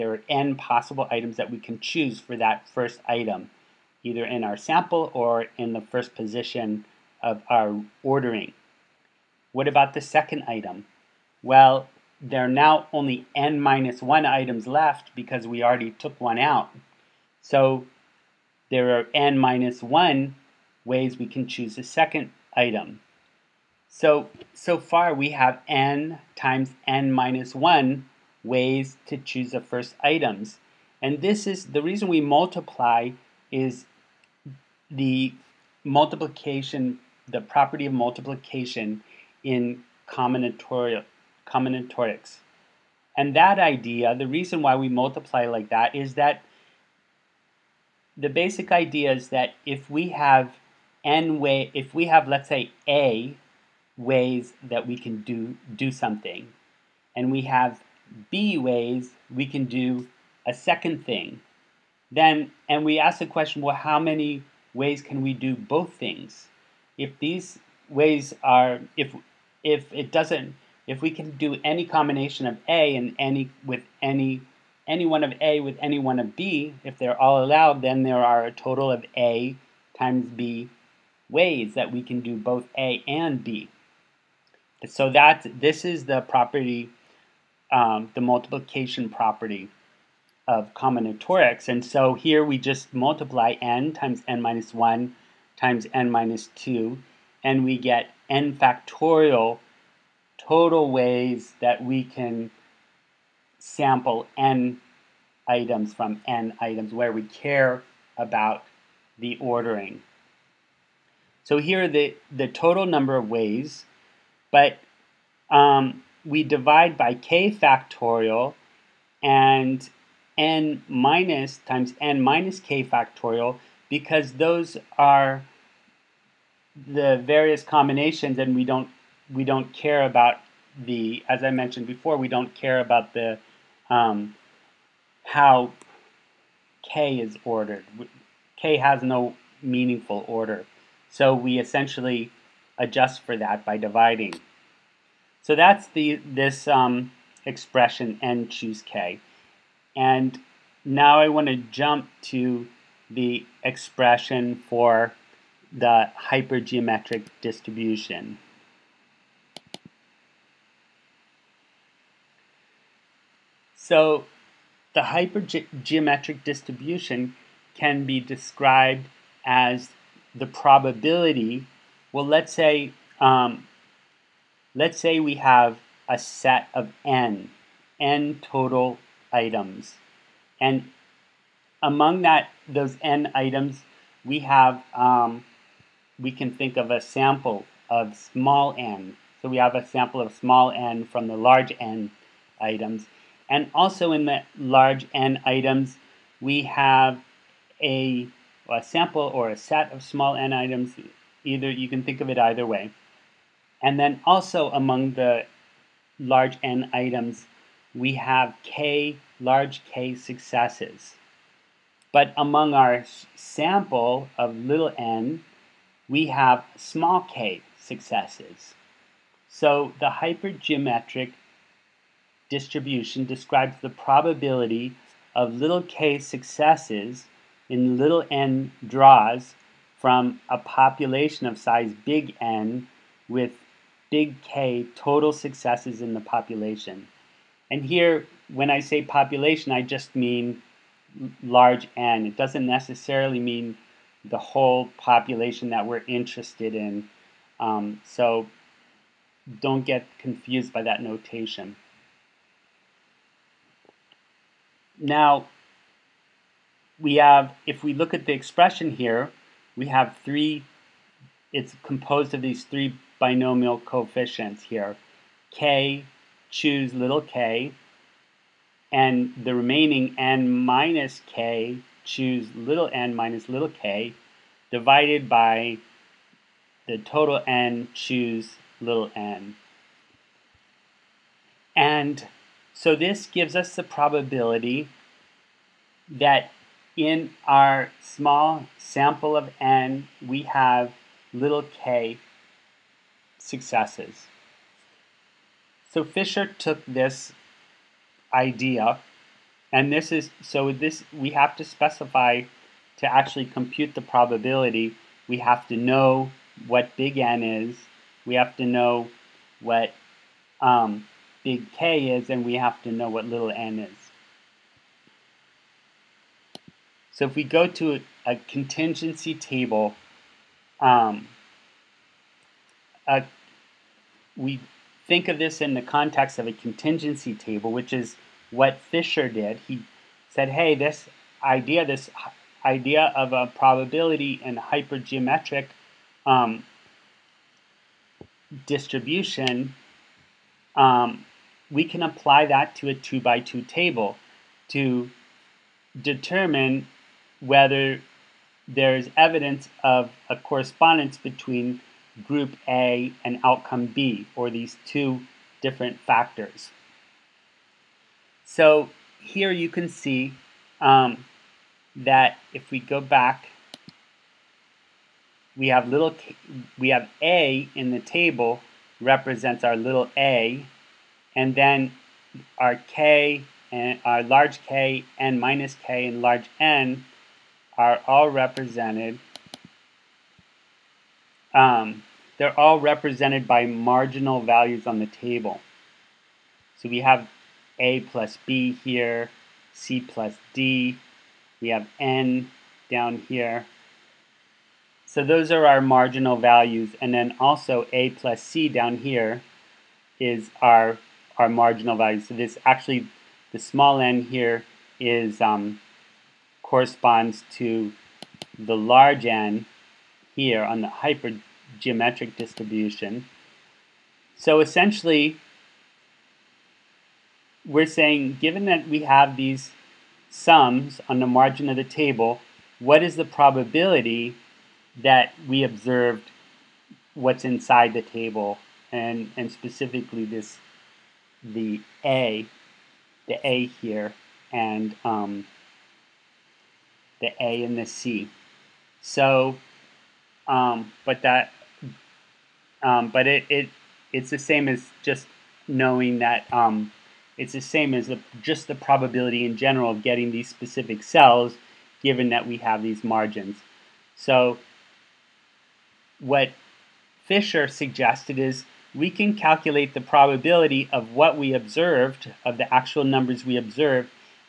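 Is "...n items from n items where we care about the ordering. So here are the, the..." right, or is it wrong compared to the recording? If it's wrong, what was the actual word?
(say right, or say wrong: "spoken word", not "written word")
right.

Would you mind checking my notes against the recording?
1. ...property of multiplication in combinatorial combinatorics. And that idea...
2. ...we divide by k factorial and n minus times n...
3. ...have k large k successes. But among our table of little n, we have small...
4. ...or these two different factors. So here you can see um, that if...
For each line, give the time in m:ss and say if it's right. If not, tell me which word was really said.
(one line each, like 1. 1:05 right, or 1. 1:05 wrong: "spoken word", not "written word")
1. 0:37 right
2. 1:56 right
3. 3:28 wrong: "sample", not "table"
4. 5:54 right.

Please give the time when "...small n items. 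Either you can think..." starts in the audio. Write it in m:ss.
3:20.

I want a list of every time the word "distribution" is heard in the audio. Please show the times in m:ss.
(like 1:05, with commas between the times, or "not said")
2:37, 2:46, 3:42, 5:38, 6:52.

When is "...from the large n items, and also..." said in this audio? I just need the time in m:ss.
3:11.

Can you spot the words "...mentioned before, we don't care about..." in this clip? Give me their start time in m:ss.
2:11.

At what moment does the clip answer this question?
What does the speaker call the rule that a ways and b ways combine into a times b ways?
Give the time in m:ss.
1:28.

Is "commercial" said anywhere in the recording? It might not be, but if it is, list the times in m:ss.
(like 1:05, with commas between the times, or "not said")
not said.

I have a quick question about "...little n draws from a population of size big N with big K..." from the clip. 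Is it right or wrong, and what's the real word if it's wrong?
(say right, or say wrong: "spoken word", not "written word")
right.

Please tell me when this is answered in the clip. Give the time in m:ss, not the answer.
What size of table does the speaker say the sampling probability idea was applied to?
5:42.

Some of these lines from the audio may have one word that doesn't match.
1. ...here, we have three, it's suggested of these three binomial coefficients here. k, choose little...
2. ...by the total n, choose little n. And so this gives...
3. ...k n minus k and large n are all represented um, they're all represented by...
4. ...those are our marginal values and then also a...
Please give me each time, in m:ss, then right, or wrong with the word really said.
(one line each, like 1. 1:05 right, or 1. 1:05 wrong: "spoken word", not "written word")
1. 4:18 wrong: "composed", not "suggested"
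2. 4:35 right
3. 6:14 right
4. 6:35 right.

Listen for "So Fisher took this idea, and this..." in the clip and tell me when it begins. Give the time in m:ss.
4:55.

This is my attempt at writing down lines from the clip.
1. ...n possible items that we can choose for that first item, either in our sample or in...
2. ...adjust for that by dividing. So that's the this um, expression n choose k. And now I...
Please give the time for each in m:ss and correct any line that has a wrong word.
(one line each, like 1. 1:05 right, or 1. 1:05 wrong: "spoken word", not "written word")
1. 0:00 right
2. 2:22 right.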